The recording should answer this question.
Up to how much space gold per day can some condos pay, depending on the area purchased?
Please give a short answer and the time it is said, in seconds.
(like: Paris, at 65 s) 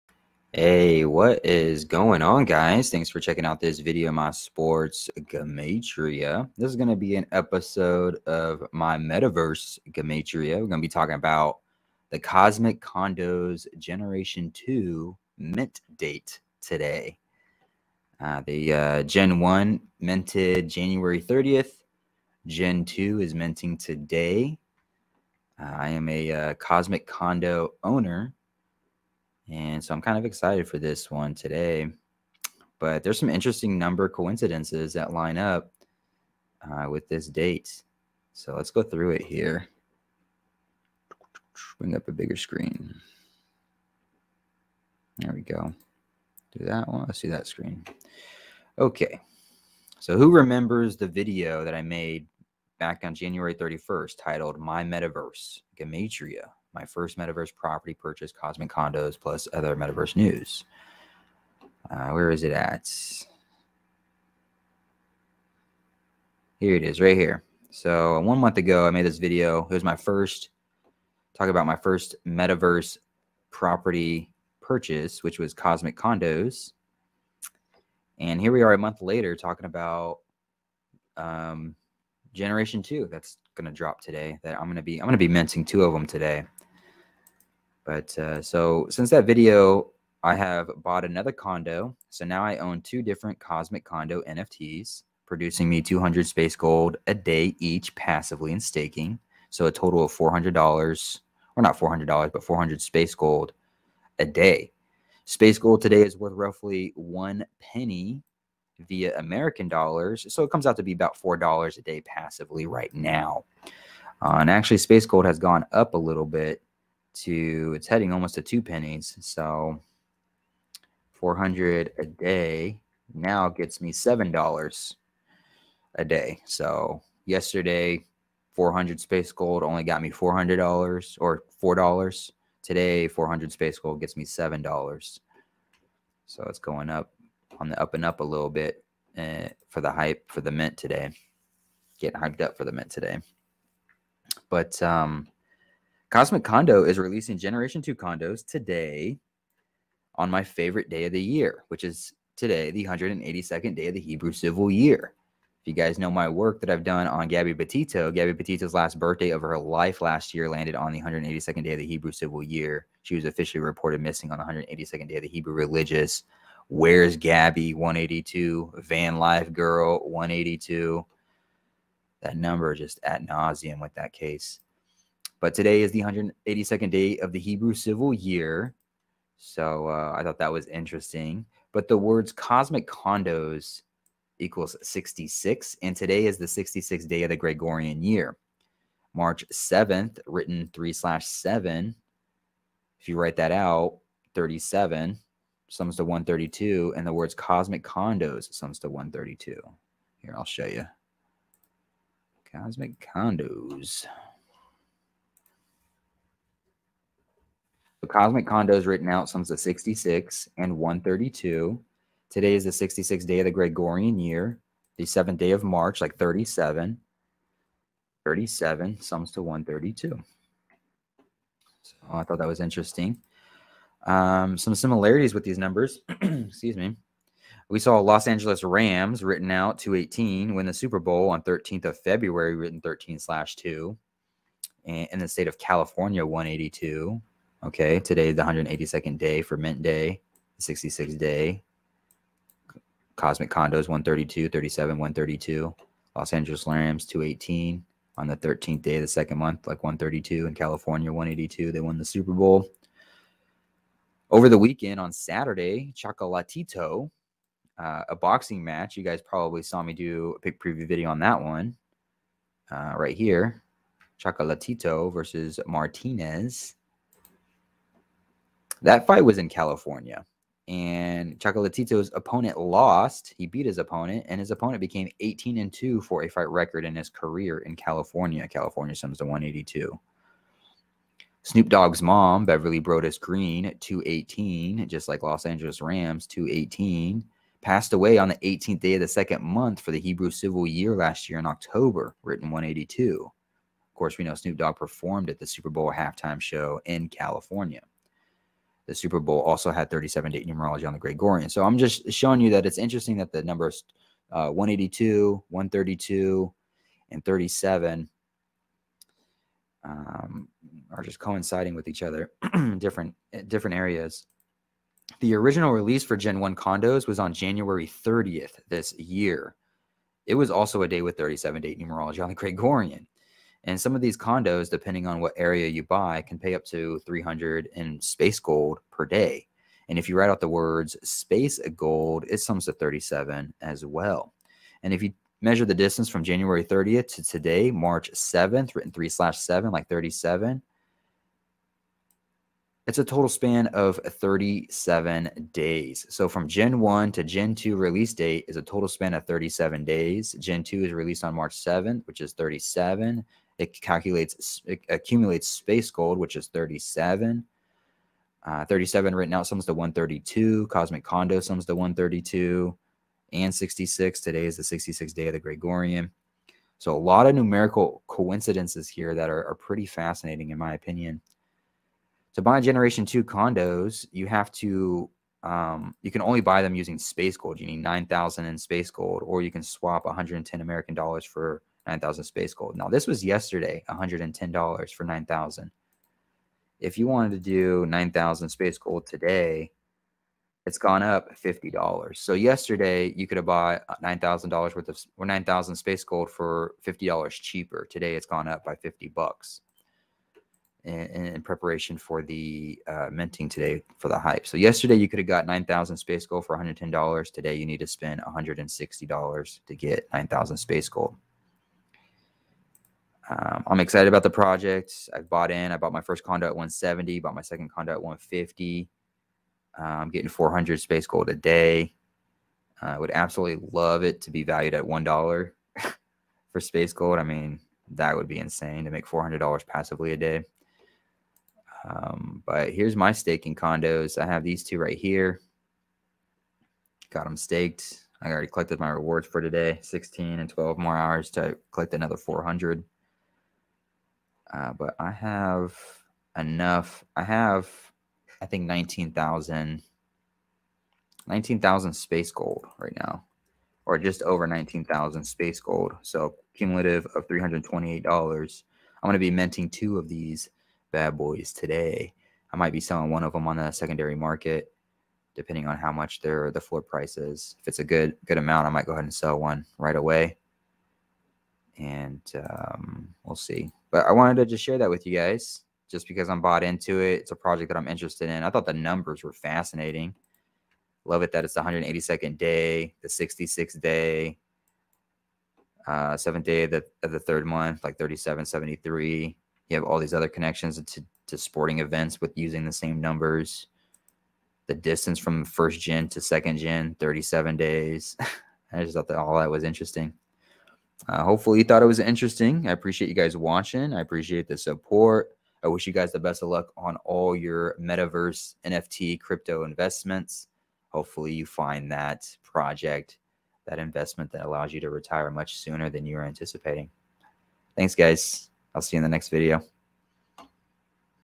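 300, at 327 s.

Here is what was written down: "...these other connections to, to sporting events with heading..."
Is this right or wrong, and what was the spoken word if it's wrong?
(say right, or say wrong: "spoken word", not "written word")
wrong: "using", not "heading".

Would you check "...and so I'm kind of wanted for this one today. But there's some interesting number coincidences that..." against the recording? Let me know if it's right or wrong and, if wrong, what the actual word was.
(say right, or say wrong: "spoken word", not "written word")
wrong: "excited", not "wanted".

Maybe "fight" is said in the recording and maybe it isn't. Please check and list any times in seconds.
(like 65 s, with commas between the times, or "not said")
269 s, 276 s.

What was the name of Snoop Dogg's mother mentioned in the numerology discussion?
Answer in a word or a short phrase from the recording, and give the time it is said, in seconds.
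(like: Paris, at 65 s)
Beverly Broadus Green, at 282 s.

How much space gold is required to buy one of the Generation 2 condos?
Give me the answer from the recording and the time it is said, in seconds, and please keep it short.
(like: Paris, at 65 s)
9,000, at 377 s.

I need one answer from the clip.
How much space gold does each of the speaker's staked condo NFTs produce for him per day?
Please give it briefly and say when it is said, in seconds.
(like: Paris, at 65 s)
200, at 95 s.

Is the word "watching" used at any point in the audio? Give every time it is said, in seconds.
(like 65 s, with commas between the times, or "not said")
503 s.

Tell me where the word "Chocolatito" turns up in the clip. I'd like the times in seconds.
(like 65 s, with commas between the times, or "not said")
255 s, 264 s, 271 s.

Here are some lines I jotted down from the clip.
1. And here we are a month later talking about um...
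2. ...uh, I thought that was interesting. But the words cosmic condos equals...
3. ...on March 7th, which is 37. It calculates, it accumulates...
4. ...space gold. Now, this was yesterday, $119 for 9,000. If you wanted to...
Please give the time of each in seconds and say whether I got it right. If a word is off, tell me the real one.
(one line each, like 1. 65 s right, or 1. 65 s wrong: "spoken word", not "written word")
1. 78 s right
2. 179 s right
3. 351 s right
4. 382 s wrong: "110", not "119".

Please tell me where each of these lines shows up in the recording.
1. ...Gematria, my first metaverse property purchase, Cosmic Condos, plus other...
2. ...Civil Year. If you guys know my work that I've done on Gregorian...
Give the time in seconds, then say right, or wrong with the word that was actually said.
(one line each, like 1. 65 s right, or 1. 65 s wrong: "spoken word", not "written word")
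1. 55 s right
2. 154 s wrong: "Gabby", not "Gregorian".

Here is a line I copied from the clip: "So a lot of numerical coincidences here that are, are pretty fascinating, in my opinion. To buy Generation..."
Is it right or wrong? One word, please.
right.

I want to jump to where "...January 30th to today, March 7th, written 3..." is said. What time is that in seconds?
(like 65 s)
336 s.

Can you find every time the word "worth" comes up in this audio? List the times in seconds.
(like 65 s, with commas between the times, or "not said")
106 s, 394 s.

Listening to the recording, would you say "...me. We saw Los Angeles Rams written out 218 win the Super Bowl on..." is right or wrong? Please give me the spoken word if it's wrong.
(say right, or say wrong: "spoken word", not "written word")
right.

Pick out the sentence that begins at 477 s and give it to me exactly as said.
It's a project that I'm interested in.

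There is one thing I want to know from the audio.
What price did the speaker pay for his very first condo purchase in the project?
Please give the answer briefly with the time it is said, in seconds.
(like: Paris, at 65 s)
170, at 416 s.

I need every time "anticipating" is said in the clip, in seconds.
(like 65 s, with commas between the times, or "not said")
516 s.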